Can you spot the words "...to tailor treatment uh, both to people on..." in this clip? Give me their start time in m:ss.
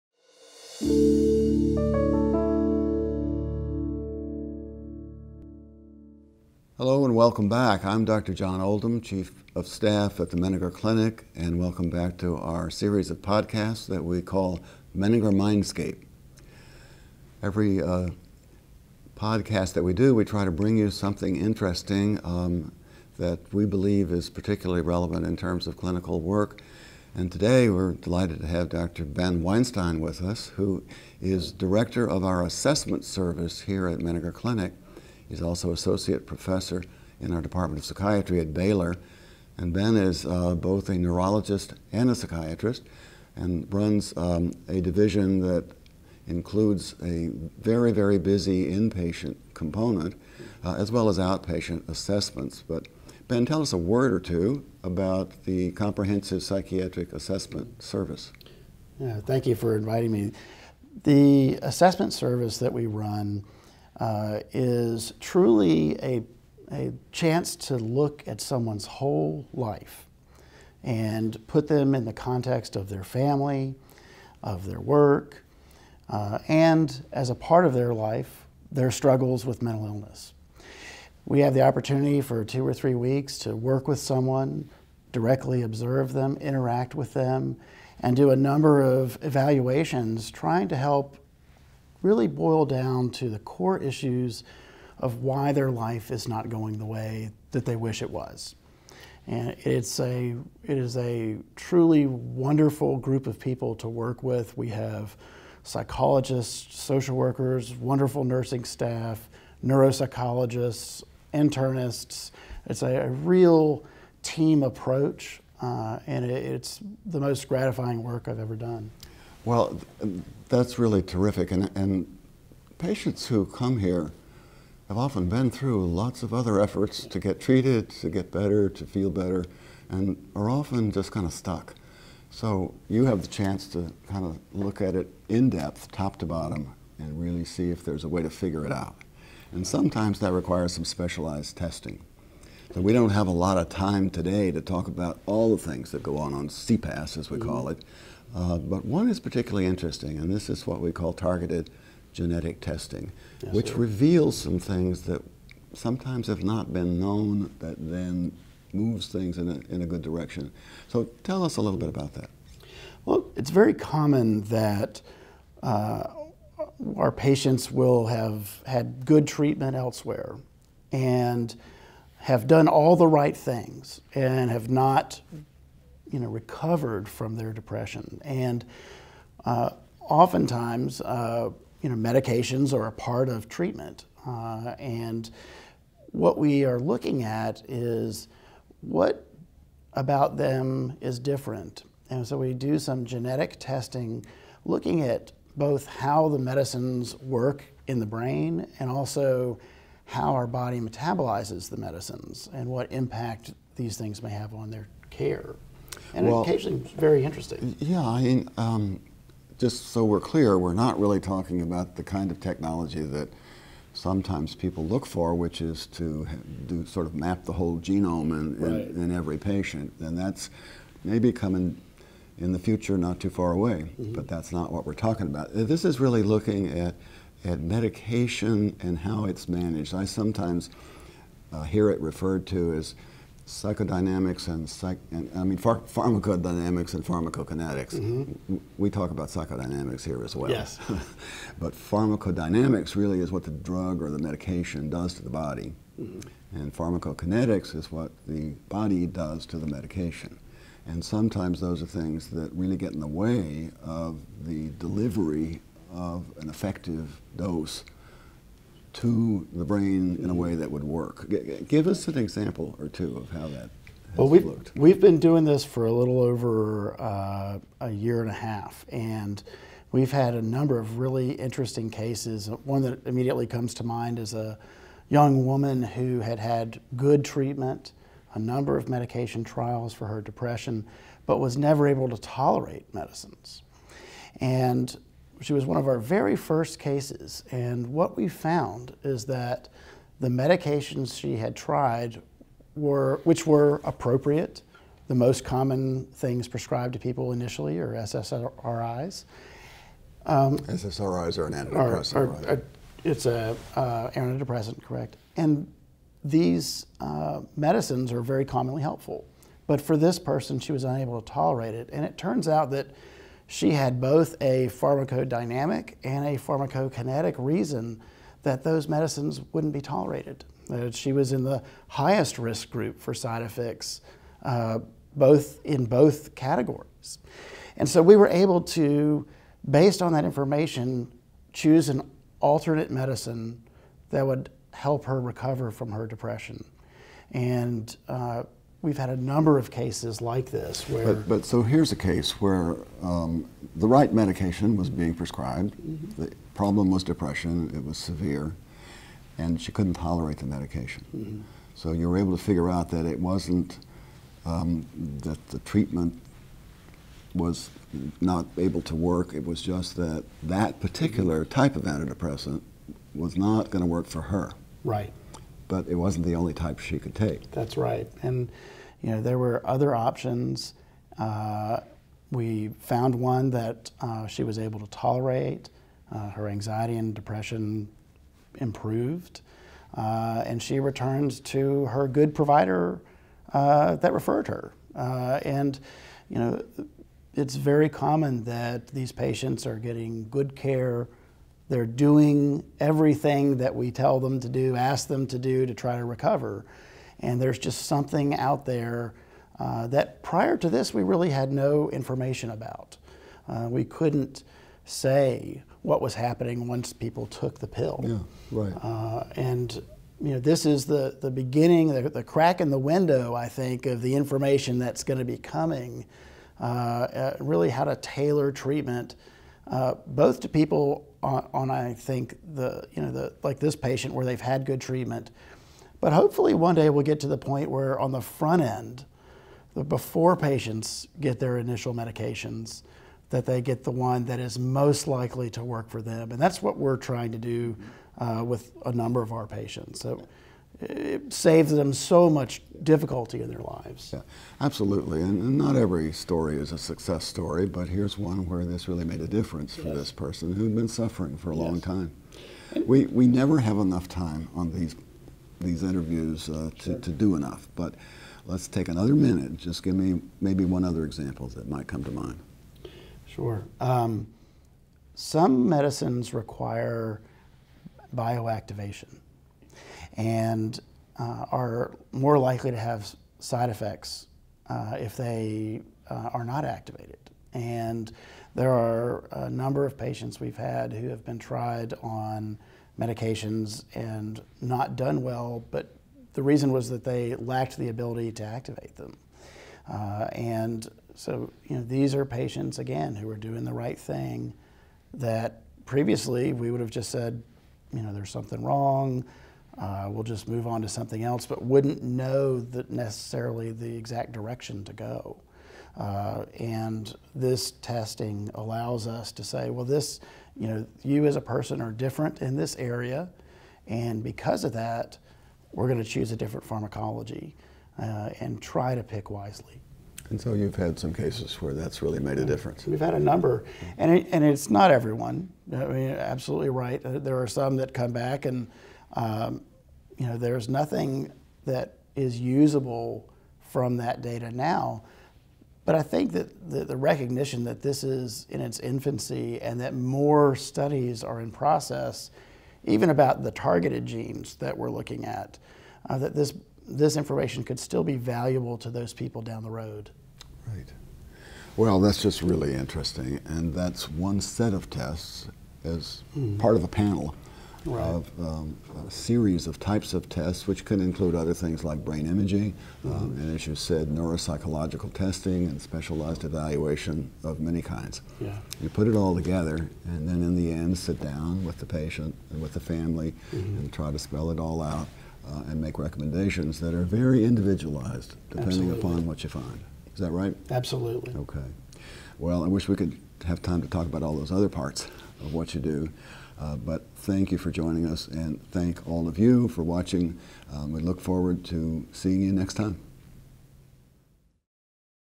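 6:57.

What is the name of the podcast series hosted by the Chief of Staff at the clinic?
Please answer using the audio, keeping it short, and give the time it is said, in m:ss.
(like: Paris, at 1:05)
Menninger Mindscape, at 0:14.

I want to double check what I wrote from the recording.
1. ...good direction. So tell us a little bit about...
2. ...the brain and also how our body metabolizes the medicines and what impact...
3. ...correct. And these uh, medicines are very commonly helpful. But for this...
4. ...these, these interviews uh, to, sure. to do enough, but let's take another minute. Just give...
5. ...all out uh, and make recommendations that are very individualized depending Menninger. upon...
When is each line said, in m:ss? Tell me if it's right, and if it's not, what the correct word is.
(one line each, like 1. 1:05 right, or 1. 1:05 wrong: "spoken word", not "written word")
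1. 2:39 right
2. 3:17 right
3. 5:04 right
4. 7:34 right
5. 9:34 wrong: "Absolutely", not "Menninger".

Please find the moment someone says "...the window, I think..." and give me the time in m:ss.
6:52.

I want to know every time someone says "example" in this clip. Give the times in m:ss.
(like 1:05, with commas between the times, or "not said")
4:22, 7:41.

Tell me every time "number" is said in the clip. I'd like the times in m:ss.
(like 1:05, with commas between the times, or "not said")
1:28, 4:30, 4:38, 5:39, 7:18, 7:59, 8:43.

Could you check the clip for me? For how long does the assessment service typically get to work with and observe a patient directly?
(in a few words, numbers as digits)
two or three weeks.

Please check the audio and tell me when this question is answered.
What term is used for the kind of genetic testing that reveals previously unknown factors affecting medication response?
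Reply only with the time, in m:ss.
2:31.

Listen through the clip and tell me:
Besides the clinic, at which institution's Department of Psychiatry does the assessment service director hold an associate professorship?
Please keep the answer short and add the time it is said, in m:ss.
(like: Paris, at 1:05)
Baylor, at 0:38.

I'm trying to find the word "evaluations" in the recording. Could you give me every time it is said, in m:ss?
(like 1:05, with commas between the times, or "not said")
1:29, 9:26.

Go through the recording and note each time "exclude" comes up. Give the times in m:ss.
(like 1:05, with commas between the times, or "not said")
not said.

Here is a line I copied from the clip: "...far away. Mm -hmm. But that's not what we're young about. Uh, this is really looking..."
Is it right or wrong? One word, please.
wrong.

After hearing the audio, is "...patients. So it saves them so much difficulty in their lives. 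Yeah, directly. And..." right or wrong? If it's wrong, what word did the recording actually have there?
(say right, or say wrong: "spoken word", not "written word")
wrong: "absolutely", not "directly".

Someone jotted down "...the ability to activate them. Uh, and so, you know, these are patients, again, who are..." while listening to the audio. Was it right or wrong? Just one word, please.
right.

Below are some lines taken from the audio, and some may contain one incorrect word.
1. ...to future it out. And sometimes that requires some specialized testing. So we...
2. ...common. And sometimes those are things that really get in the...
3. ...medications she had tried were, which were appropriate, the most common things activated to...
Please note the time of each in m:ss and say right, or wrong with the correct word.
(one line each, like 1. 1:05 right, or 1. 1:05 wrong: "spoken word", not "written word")
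1. 2:18 wrong: "figure", not "future"
2. 4:09 wrong: "medication", not "common"
3. 4:50 wrong: "prescribed", not "activated".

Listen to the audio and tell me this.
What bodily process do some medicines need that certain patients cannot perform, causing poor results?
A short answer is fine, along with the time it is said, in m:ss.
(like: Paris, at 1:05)
bioactivation, at 7:48.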